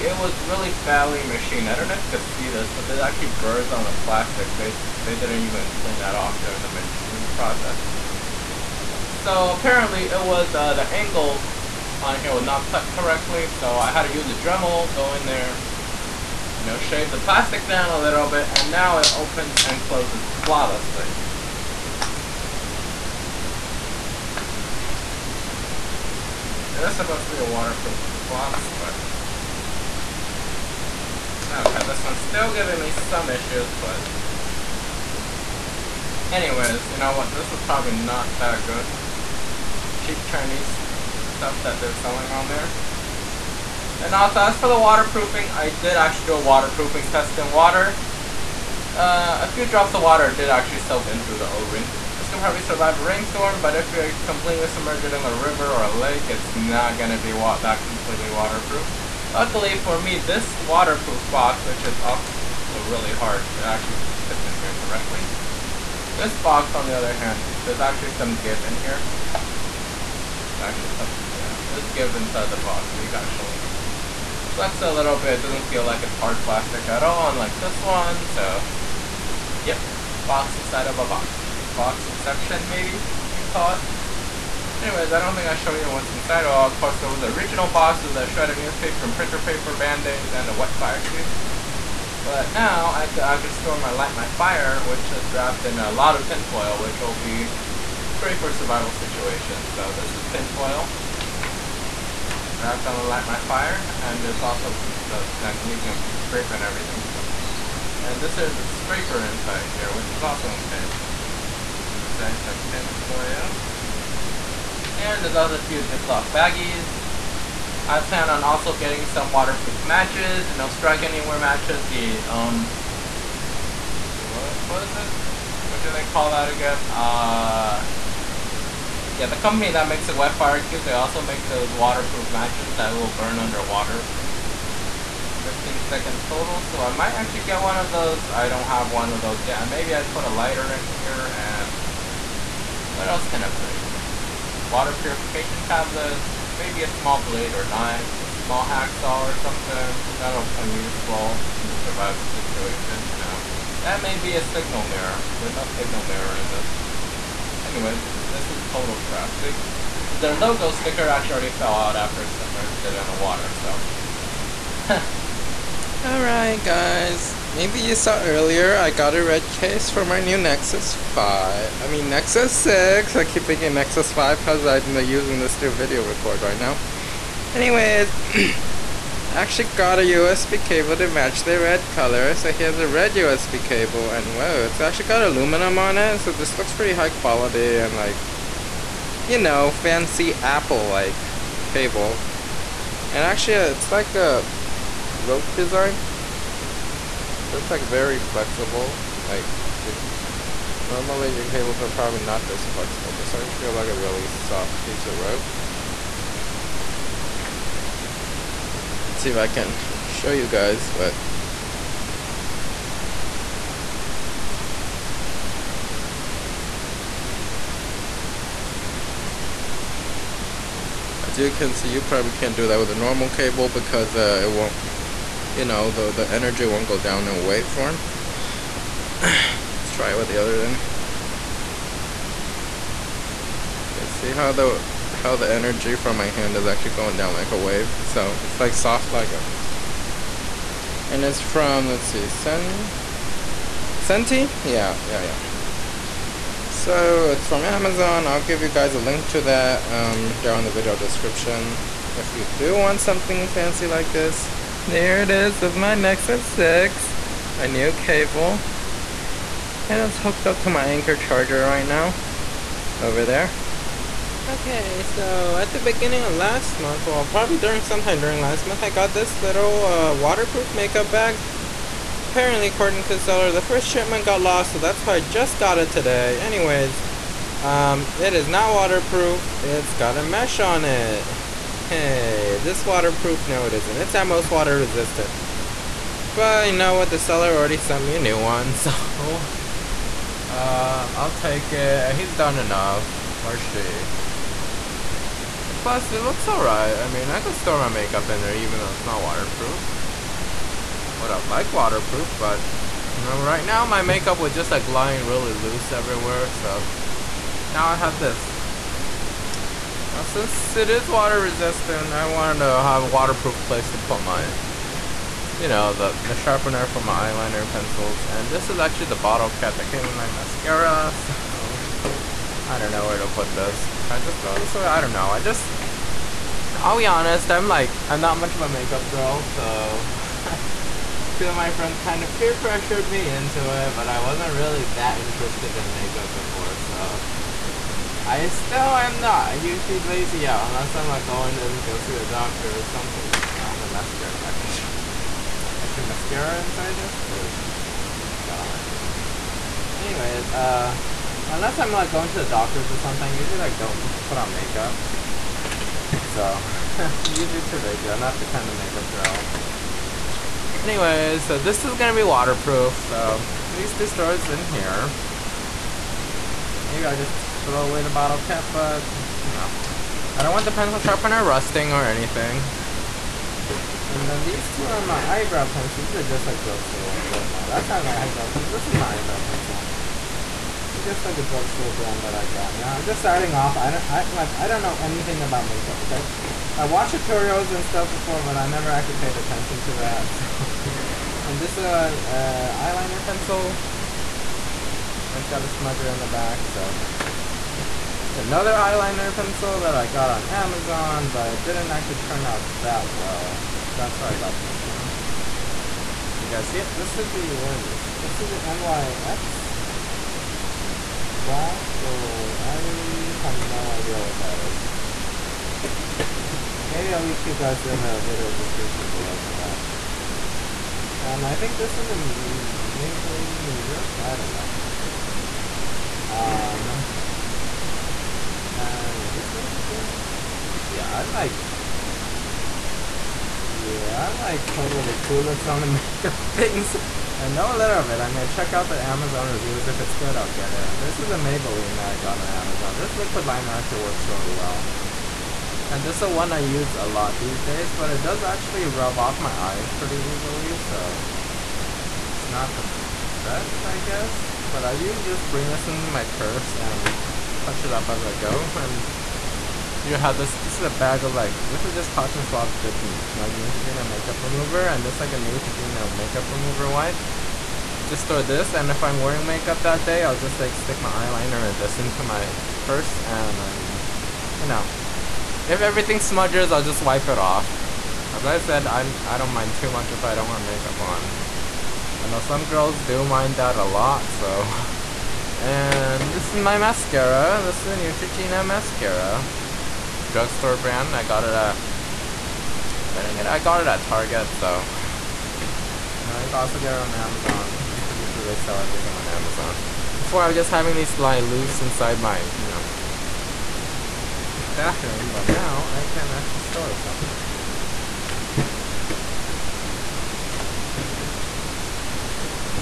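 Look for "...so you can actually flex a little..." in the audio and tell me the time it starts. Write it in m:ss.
1:12.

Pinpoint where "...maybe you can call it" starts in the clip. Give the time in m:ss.
1:22.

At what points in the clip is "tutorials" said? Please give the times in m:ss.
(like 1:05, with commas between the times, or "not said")
6:27.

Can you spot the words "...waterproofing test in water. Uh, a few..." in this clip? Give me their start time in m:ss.
0:46.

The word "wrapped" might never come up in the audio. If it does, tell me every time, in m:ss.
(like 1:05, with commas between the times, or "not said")
1:35, 1:42.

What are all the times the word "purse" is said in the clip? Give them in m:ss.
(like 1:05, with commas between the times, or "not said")
7:36, 7:52.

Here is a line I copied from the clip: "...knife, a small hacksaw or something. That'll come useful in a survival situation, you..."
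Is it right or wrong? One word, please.
right.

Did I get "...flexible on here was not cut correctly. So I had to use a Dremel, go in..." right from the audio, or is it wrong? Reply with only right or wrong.
wrong.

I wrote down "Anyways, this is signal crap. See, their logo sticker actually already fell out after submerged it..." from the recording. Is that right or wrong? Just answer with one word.
wrong.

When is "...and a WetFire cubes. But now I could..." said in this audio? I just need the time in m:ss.
1:30.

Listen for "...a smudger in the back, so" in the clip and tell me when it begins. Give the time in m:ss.
6:35.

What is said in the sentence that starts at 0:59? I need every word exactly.
Luckily for me, this waterproof box, which is also really hard, it actually fits in here correctly.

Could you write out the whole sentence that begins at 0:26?
That's supposed to be a waterproof box, but yeah.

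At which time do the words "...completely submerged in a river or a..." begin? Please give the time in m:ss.
0:54.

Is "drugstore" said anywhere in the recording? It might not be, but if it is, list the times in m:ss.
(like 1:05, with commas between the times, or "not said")
6:16, 6:21, 8:10.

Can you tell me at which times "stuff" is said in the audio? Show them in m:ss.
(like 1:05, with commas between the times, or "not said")
0:41, 6:27.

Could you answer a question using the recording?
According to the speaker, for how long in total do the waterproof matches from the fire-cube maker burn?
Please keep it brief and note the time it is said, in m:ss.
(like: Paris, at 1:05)
15 seconds, at 2:15.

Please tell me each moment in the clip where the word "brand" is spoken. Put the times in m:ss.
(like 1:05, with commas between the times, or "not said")
6:21, 8:10.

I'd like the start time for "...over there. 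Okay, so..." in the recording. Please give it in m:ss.
4:22.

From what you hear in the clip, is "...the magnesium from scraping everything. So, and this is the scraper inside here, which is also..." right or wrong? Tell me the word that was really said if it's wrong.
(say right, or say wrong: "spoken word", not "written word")
right.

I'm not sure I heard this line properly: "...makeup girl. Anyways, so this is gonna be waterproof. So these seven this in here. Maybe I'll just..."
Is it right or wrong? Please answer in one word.
wrong.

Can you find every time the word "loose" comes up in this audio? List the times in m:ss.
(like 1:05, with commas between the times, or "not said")
5:05, 8:21.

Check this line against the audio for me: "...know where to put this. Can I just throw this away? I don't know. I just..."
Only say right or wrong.
right.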